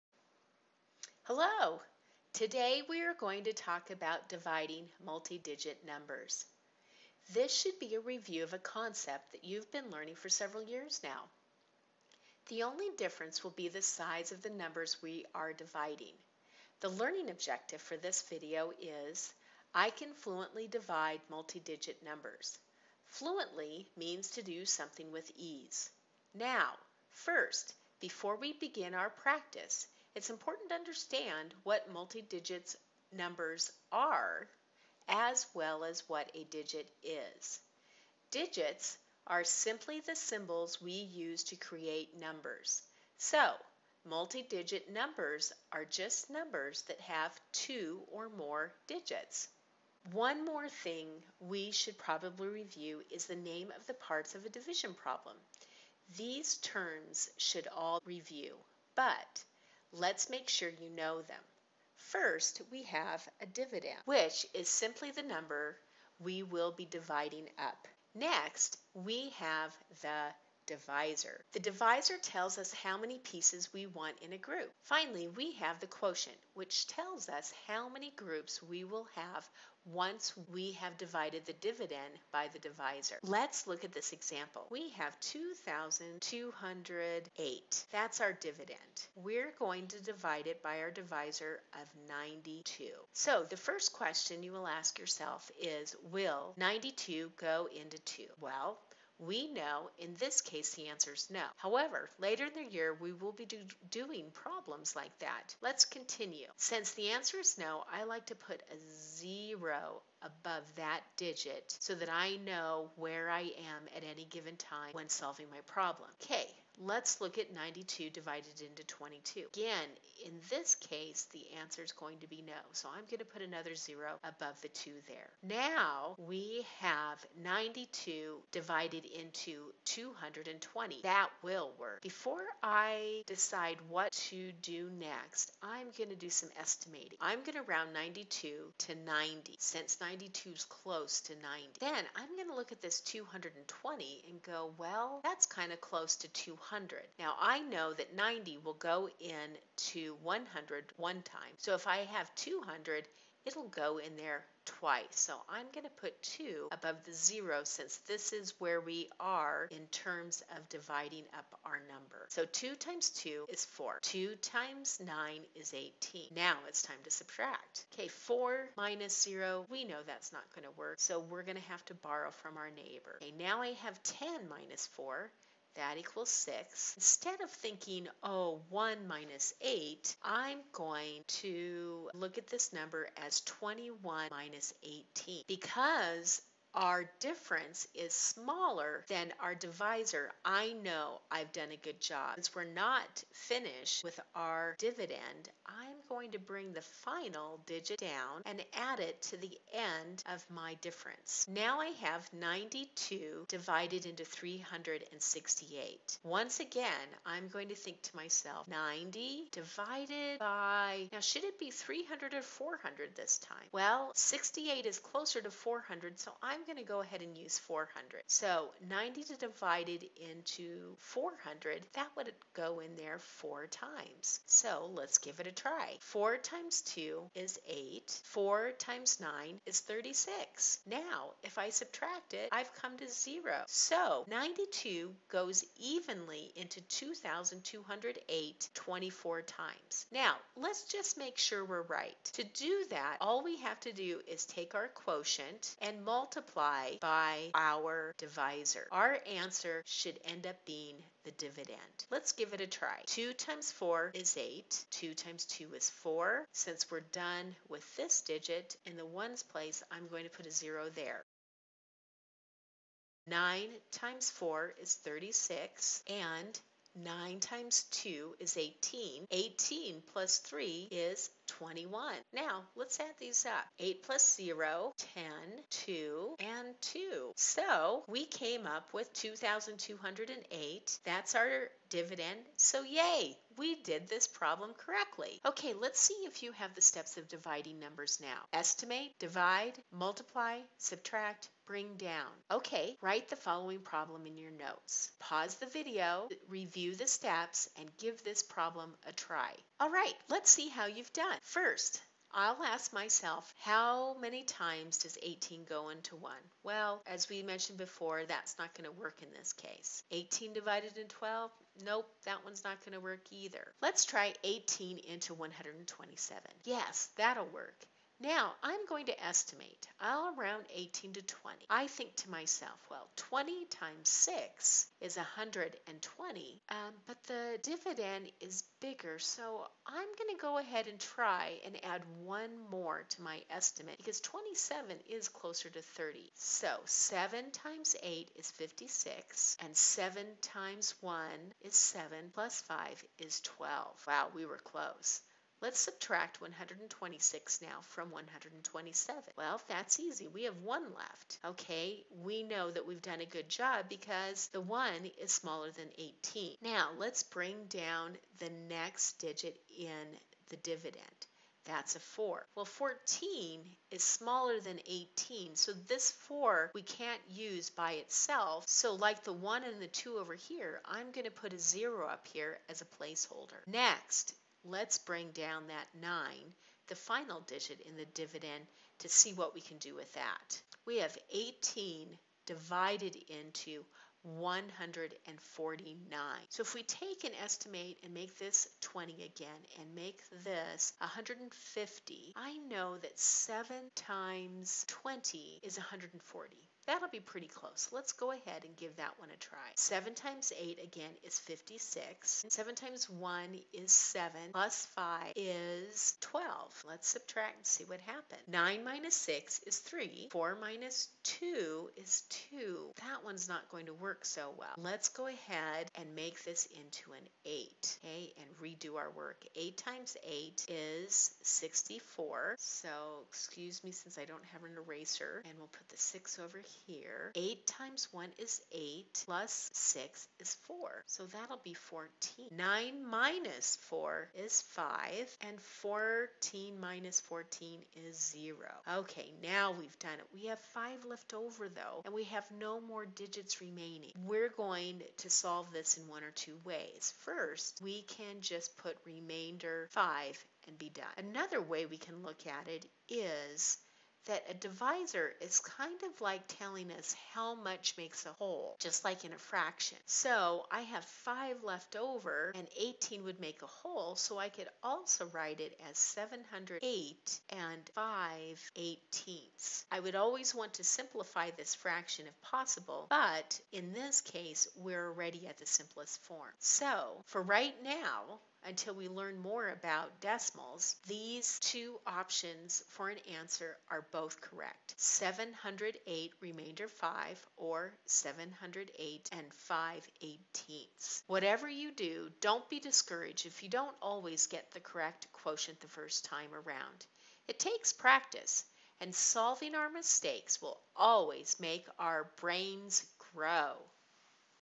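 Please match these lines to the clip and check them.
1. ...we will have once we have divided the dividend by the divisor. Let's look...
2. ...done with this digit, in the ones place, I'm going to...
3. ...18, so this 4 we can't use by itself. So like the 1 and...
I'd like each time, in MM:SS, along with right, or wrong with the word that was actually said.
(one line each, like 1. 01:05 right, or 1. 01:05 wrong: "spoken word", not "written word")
1. 01:18 right
2. 04:17 right
3. 06:04 right.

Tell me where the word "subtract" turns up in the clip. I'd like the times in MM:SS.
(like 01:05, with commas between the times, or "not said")
02:47, 03:51, 04:50, 05:45, 06:47.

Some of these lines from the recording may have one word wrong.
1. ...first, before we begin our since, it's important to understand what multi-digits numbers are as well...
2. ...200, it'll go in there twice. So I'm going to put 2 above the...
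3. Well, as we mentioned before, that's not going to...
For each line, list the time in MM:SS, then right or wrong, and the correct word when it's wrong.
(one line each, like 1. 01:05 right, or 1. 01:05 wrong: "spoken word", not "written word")
1. 00:27 wrong: "practice", not "since"
2. 02:32 right
3. 05:06 right.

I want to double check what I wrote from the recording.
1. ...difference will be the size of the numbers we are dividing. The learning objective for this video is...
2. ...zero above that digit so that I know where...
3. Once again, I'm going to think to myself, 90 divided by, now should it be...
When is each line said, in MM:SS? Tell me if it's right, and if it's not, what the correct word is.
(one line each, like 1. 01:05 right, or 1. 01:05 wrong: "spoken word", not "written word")
1. 00:12 right
2. 01:48 right
3. 03:26 right.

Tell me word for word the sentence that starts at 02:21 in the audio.
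Then I'm going to look at this 220 and go, well, that's kind of close to 200.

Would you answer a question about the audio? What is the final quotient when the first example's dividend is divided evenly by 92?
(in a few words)
24.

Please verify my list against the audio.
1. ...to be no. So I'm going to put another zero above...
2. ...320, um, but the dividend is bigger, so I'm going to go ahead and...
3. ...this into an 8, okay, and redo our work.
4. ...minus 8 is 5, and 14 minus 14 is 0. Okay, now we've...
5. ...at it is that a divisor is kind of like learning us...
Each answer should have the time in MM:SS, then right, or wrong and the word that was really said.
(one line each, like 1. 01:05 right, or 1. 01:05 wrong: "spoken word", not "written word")
1. 02:02 right
2. 05:25 wrong: "120", not "320"
3. 06:56 right
4. 07:13 wrong: "4", not "8"
5. 07:32 wrong: "telling", not "learning".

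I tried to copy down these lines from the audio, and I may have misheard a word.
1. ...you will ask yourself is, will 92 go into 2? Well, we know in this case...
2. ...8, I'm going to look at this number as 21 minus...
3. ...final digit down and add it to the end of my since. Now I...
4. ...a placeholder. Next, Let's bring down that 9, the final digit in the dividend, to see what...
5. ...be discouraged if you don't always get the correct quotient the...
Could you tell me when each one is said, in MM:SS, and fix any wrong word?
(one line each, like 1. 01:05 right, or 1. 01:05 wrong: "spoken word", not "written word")
1. 01:34 right
2. 02:59 right
3. 03:16 wrong: "difference", not "since"
4. 06:12 right
5. 08:12 right.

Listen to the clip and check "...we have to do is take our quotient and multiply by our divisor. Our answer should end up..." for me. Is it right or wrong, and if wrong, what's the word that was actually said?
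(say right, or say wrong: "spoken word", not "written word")
right.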